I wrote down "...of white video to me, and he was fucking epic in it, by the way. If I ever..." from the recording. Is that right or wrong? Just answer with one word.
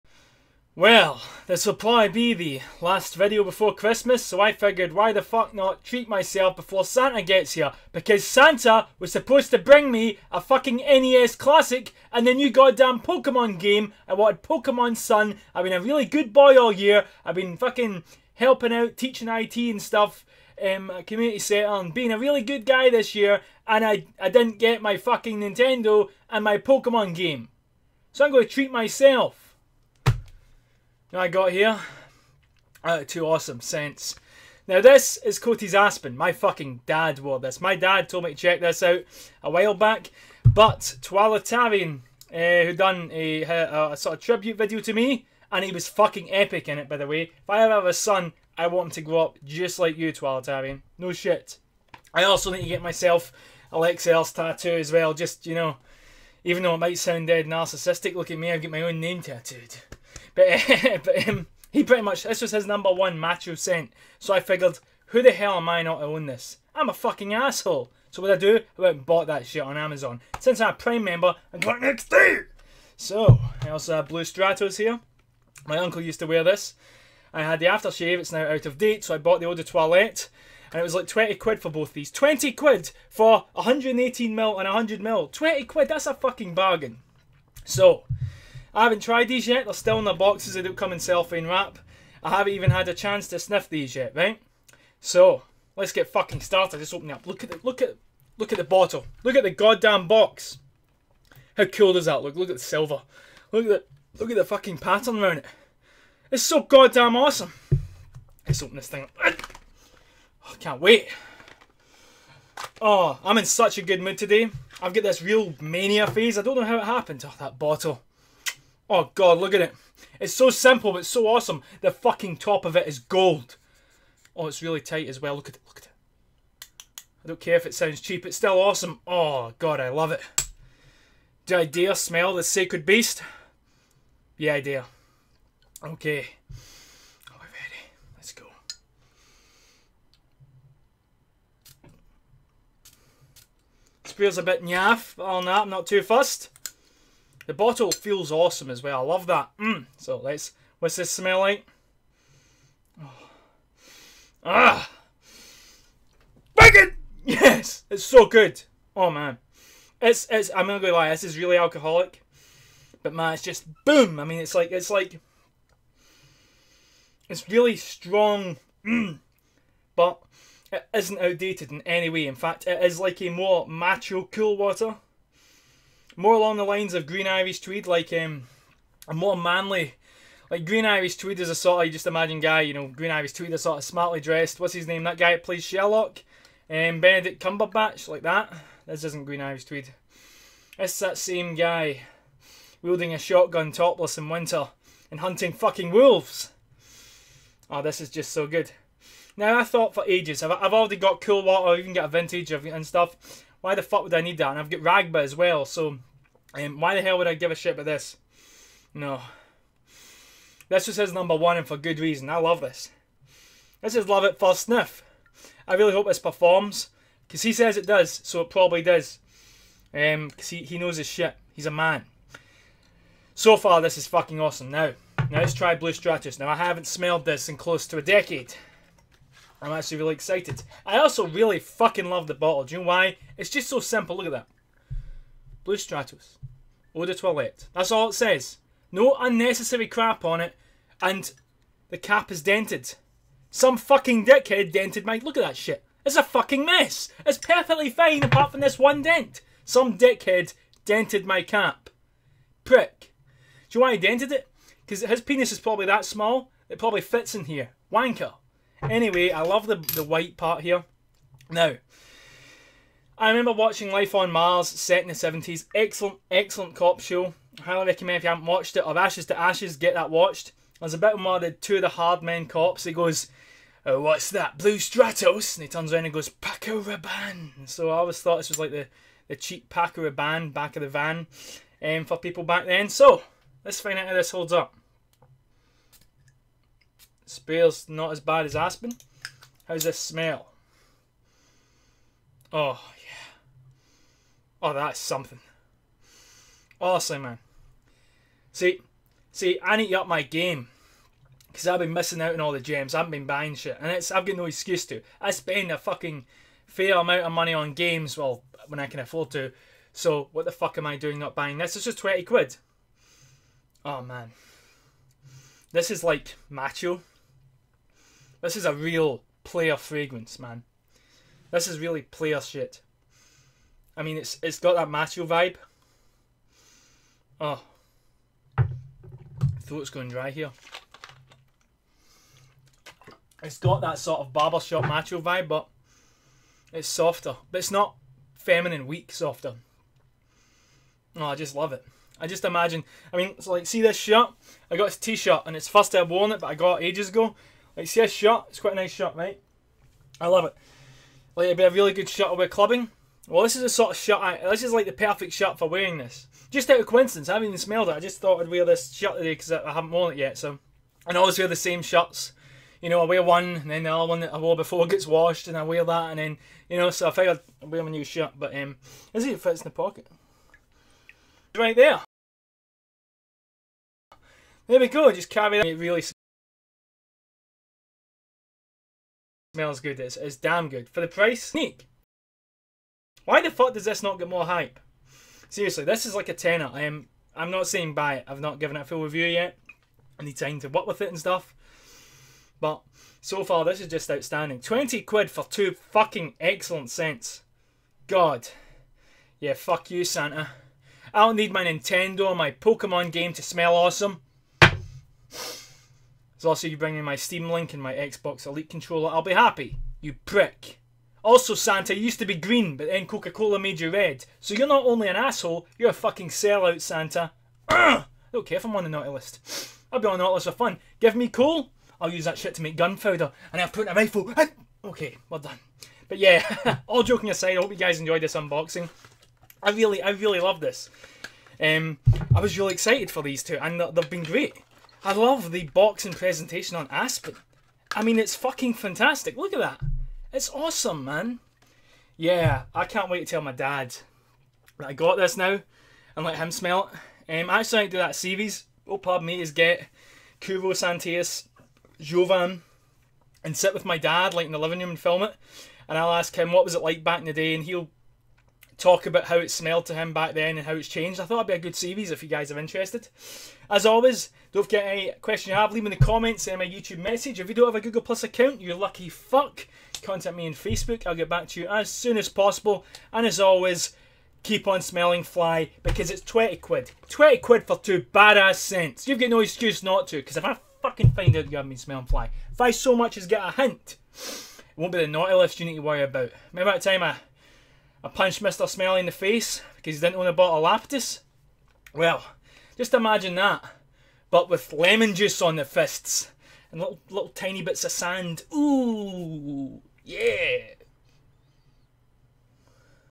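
wrong.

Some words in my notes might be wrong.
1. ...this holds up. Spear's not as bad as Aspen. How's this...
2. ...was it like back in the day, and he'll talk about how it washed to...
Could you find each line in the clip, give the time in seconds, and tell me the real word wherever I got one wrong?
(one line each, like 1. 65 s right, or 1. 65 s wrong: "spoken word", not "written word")
1. 284 s right
2. 456 s wrong: "smelled", not "washed".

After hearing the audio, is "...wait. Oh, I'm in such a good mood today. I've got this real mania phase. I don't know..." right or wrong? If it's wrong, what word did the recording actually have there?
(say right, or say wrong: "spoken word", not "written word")
right.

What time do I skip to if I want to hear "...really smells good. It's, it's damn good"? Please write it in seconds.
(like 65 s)
375 s.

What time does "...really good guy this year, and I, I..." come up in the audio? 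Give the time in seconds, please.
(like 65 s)
22 s.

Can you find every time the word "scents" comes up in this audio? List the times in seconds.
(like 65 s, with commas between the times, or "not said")
33 s, 63 s, 396 s, 478 s.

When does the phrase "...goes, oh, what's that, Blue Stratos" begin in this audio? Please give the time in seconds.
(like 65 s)
272 s.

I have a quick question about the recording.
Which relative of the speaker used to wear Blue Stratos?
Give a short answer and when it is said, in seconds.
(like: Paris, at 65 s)
uncle, at 75 s.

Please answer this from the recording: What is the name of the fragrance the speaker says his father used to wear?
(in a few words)
Coty's Aspen.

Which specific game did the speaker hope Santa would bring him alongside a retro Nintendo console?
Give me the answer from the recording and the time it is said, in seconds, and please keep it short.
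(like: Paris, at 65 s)
Pokemon Sun, at 14 s.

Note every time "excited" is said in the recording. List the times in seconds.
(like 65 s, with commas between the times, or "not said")
230 s, 432 s.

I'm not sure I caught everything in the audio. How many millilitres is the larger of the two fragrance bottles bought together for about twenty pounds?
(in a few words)
118.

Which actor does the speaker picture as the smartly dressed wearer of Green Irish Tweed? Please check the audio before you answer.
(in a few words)
Benedict Cumberbatch.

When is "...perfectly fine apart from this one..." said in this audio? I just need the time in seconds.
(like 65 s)
247 s.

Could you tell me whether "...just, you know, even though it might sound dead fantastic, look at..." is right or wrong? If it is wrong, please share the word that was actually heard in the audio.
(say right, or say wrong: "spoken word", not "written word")
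wrong: "narcissistic", not "fantastic".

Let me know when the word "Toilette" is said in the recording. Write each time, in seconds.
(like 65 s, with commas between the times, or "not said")
79 s, 237 s.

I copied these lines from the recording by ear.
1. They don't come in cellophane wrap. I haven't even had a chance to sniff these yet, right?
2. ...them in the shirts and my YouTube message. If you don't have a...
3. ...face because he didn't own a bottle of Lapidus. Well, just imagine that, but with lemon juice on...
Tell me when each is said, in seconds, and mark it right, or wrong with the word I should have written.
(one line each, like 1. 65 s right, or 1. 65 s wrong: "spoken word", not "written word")
1. 90 s right
2. 465 s wrong: "comments", not "shirts"
3. 489 s right.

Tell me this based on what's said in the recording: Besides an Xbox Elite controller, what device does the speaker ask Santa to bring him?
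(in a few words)
Steam Link.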